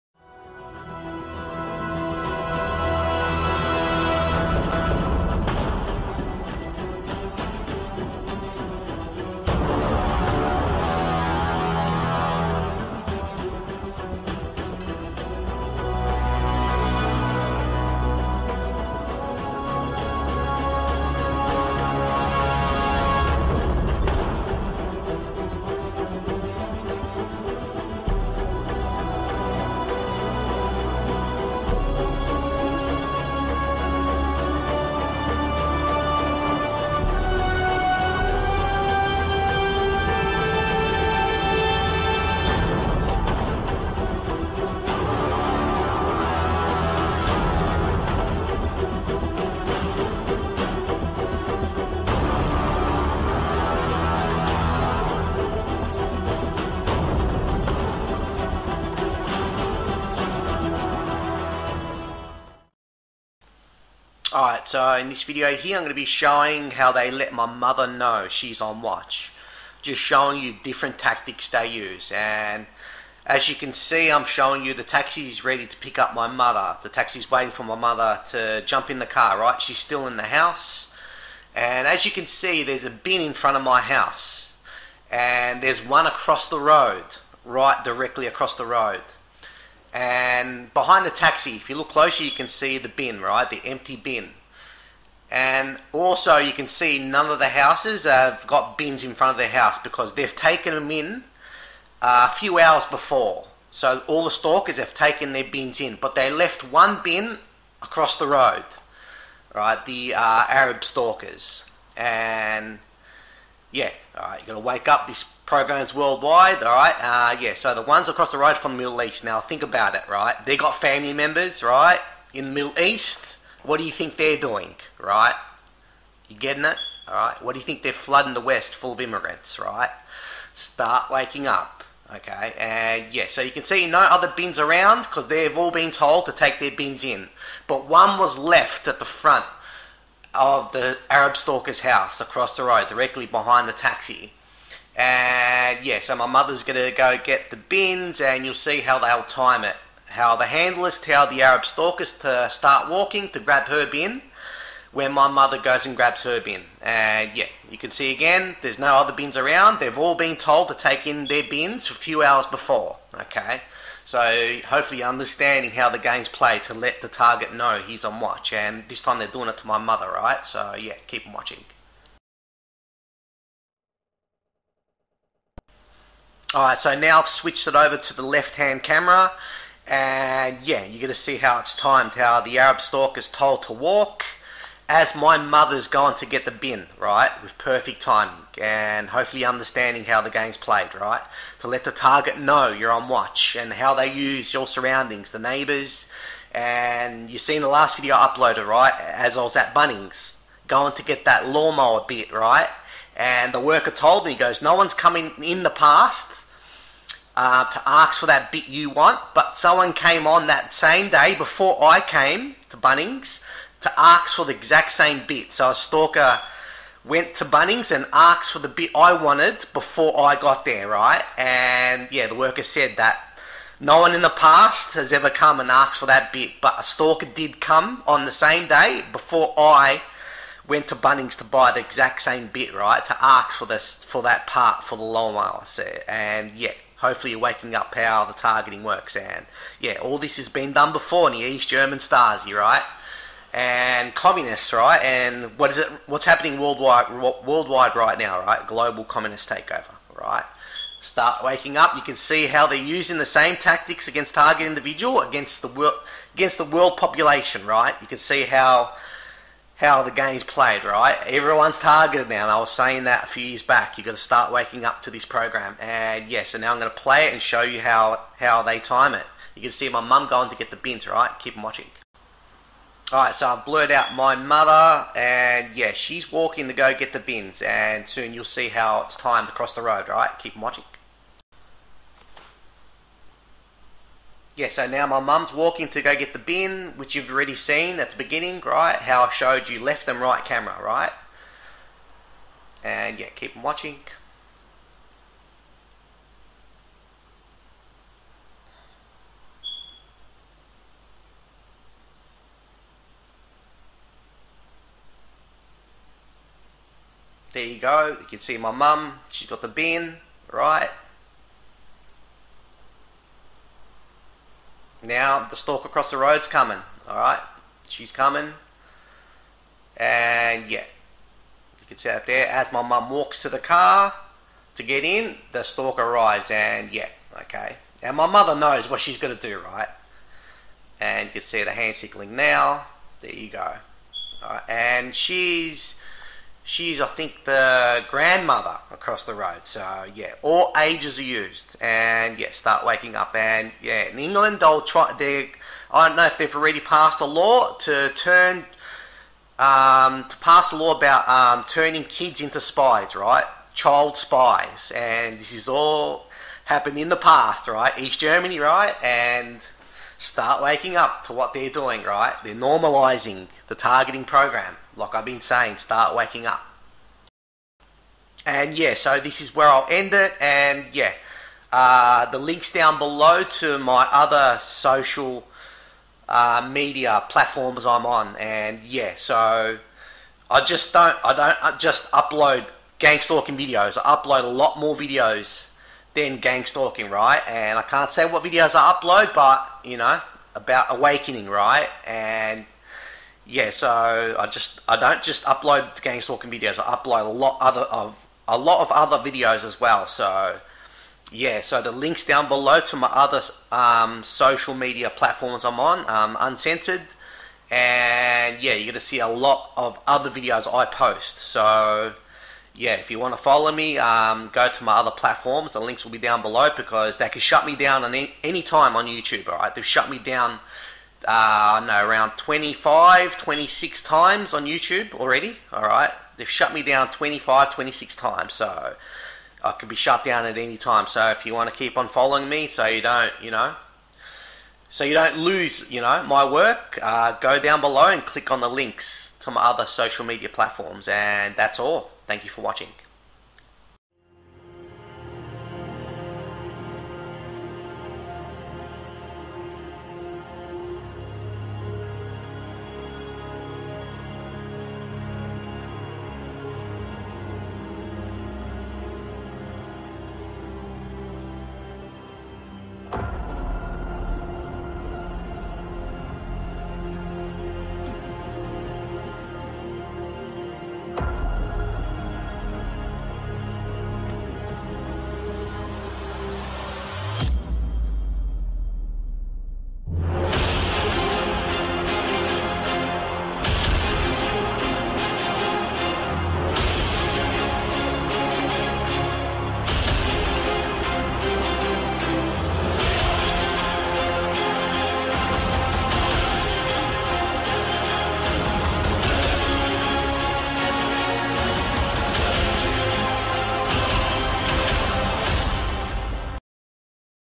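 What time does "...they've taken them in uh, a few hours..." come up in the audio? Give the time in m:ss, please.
1:40.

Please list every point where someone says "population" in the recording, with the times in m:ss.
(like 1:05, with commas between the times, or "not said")
4:16.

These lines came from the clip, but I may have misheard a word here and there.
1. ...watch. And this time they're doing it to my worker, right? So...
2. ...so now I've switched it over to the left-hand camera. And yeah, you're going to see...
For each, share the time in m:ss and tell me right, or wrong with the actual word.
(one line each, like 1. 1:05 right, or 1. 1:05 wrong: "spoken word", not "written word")
1. 2:48 wrong: "mother", not "worker"
2. 2:56 right.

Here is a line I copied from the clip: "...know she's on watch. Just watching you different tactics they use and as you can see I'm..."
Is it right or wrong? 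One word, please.
wrong.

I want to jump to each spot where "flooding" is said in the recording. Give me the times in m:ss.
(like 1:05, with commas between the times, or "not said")
2:07.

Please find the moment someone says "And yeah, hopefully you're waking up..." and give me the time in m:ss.
3:56.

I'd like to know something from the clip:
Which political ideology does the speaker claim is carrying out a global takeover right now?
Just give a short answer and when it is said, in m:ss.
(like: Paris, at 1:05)
Communist, at 4:08.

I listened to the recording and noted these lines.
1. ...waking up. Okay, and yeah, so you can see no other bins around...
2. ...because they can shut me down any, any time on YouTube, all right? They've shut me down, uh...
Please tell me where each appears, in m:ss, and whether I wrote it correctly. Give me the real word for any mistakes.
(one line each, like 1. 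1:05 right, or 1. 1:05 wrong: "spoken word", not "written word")
1. 2:11 right
2. 6:56 right.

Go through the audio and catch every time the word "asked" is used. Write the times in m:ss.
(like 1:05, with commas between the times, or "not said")
3:38, 3:45.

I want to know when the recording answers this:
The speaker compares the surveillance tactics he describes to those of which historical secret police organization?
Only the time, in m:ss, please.
4:01.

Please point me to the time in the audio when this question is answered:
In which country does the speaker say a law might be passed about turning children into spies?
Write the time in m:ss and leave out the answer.
5:44.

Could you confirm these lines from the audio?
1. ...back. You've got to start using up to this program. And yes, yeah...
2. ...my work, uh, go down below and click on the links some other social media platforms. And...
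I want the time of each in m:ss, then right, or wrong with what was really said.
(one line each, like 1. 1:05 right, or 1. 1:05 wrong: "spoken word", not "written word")
1. 4:23 wrong: "waking", not "using"
2. 7:16 right.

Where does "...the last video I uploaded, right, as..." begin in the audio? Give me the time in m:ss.
3:17.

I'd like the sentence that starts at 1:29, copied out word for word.
And behind the taxi, if you look closer, you can see the bin, right?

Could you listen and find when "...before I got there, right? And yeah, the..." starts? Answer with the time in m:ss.
3:39.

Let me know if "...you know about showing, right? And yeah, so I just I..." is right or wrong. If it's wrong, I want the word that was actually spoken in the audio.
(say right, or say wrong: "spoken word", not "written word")
wrong: "awakening", not "showing".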